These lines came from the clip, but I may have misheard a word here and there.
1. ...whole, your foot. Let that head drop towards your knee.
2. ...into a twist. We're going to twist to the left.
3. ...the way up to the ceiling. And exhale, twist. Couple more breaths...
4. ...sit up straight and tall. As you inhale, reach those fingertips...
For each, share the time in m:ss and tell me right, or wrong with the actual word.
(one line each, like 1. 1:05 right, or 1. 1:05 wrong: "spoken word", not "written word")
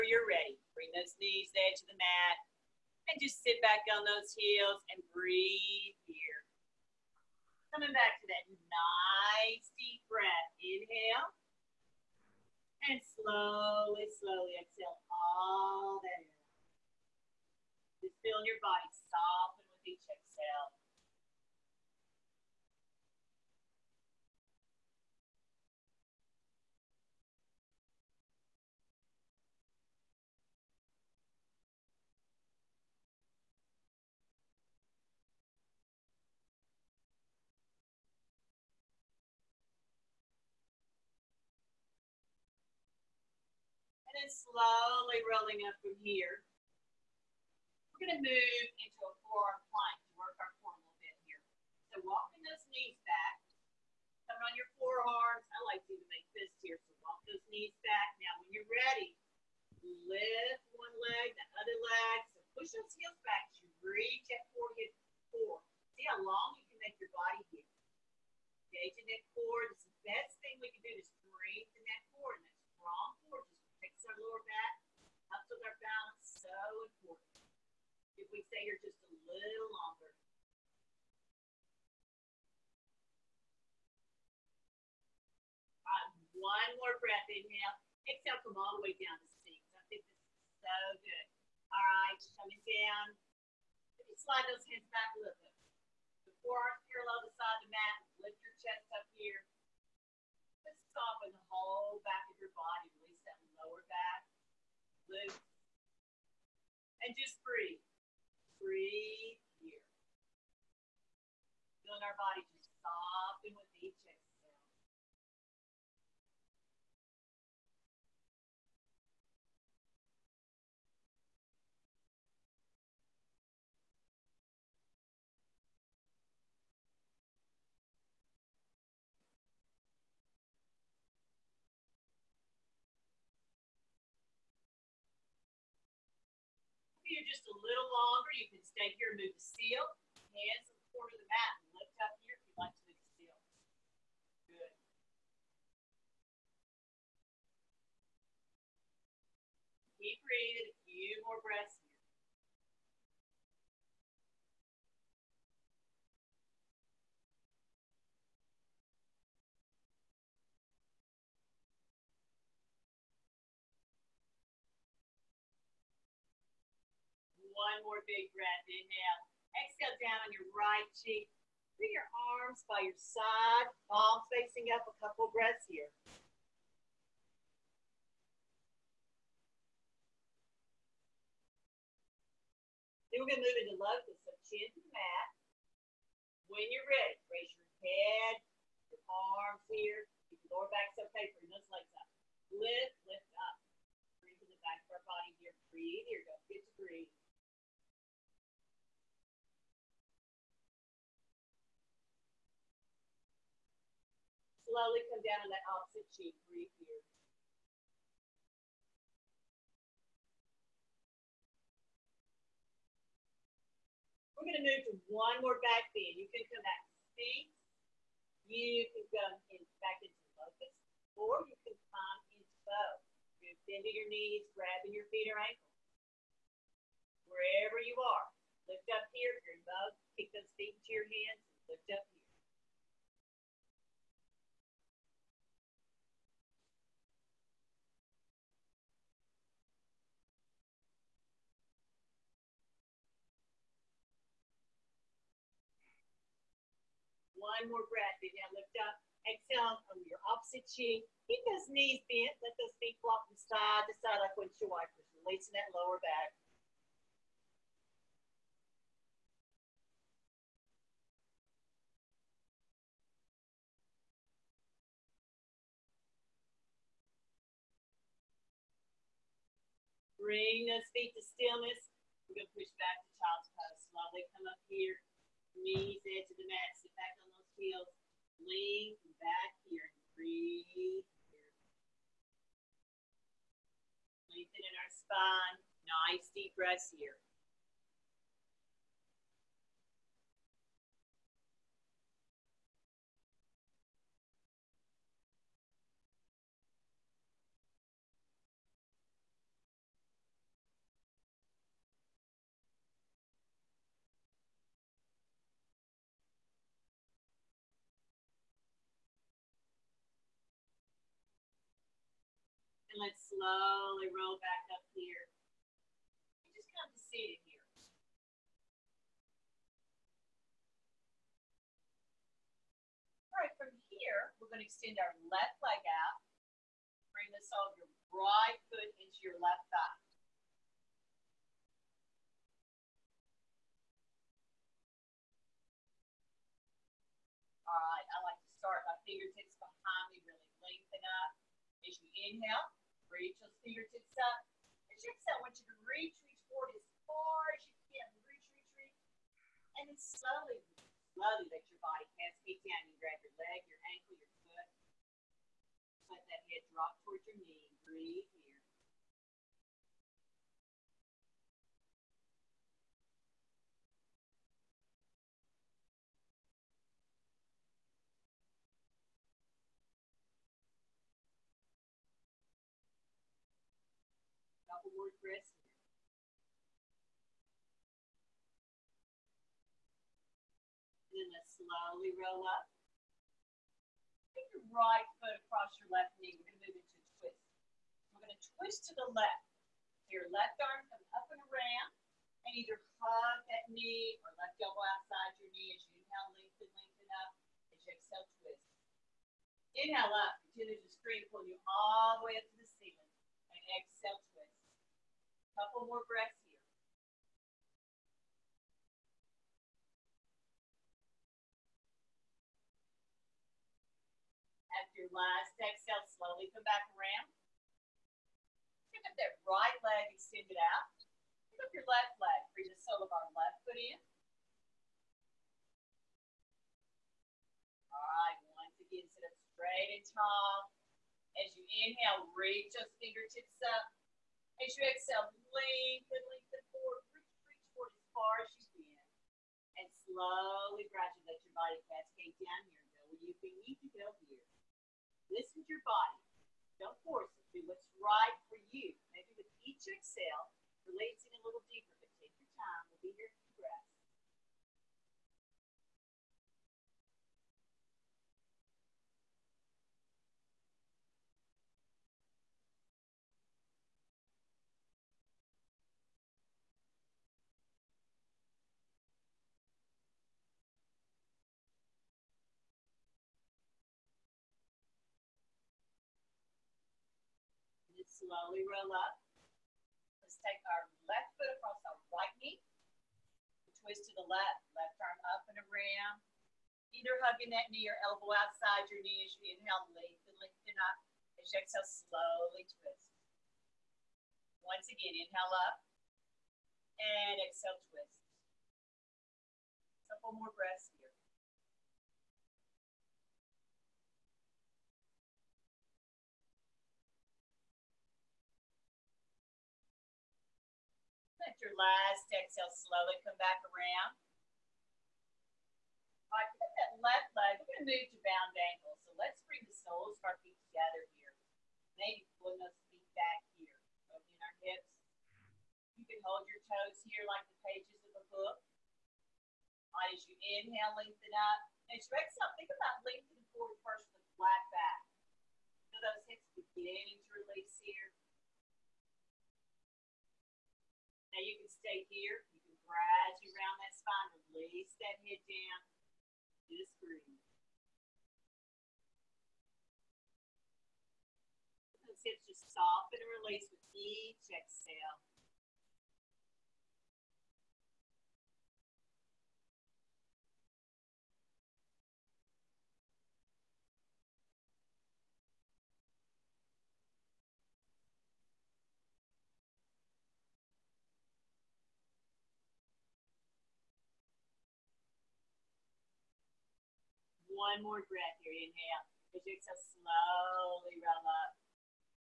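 1. 5:53 wrong: "ankle", not "whole"
2. 6:26 right
3. 6:42 right
4. 7:09 right.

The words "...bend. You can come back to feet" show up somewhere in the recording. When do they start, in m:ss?
3:35.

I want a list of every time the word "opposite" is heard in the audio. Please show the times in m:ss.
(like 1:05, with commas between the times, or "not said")
3:25, 4:10.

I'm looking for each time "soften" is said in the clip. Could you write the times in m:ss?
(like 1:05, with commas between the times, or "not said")
0:19, 1:40, 1:52, 9:12.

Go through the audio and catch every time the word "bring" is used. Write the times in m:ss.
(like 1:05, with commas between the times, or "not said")
0:00, 1:11, 2:51, 3:11, 4:30, 5:27, 7:02, 8:39.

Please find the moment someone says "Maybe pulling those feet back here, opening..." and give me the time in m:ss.
8:41.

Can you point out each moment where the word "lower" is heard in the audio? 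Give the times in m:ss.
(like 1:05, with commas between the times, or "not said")
1:14, 1:43, 3:10, 4:15.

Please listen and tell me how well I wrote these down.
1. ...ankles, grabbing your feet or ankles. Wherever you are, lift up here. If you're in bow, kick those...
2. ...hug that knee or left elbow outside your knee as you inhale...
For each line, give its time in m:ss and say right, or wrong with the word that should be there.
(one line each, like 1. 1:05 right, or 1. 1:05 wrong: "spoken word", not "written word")
1. 3:44 wrong: "knees", not "ankles"
2. 6:32 right.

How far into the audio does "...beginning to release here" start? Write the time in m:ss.
8:56.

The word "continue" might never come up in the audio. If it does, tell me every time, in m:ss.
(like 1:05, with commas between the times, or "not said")
6:40.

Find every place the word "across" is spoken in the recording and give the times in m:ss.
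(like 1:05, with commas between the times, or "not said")
6:25, 8:01.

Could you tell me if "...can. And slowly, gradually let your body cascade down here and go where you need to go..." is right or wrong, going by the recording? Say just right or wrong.
right.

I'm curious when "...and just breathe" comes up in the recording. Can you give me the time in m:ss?
1:47.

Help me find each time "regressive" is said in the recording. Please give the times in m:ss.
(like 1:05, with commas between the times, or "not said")
6:15.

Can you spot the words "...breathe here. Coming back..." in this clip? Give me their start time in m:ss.
0:05.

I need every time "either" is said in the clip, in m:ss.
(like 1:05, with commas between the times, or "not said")
6:32, 8:06.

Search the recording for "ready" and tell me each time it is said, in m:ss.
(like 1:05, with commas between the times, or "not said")
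0:00, 0:58, 3:06.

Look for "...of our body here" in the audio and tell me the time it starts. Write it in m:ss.
3:14.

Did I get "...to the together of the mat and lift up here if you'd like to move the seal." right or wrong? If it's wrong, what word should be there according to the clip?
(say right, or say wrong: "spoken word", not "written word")
wrong: "corner", not "together".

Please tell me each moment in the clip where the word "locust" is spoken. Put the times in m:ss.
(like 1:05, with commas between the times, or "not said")
3:03, 3:40.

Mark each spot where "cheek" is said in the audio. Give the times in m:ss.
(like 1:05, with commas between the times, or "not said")
2:50, 3:26, 4:10.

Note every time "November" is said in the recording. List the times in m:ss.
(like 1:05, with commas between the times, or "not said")
not said.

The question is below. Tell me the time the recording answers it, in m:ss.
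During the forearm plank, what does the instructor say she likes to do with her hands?
0:56.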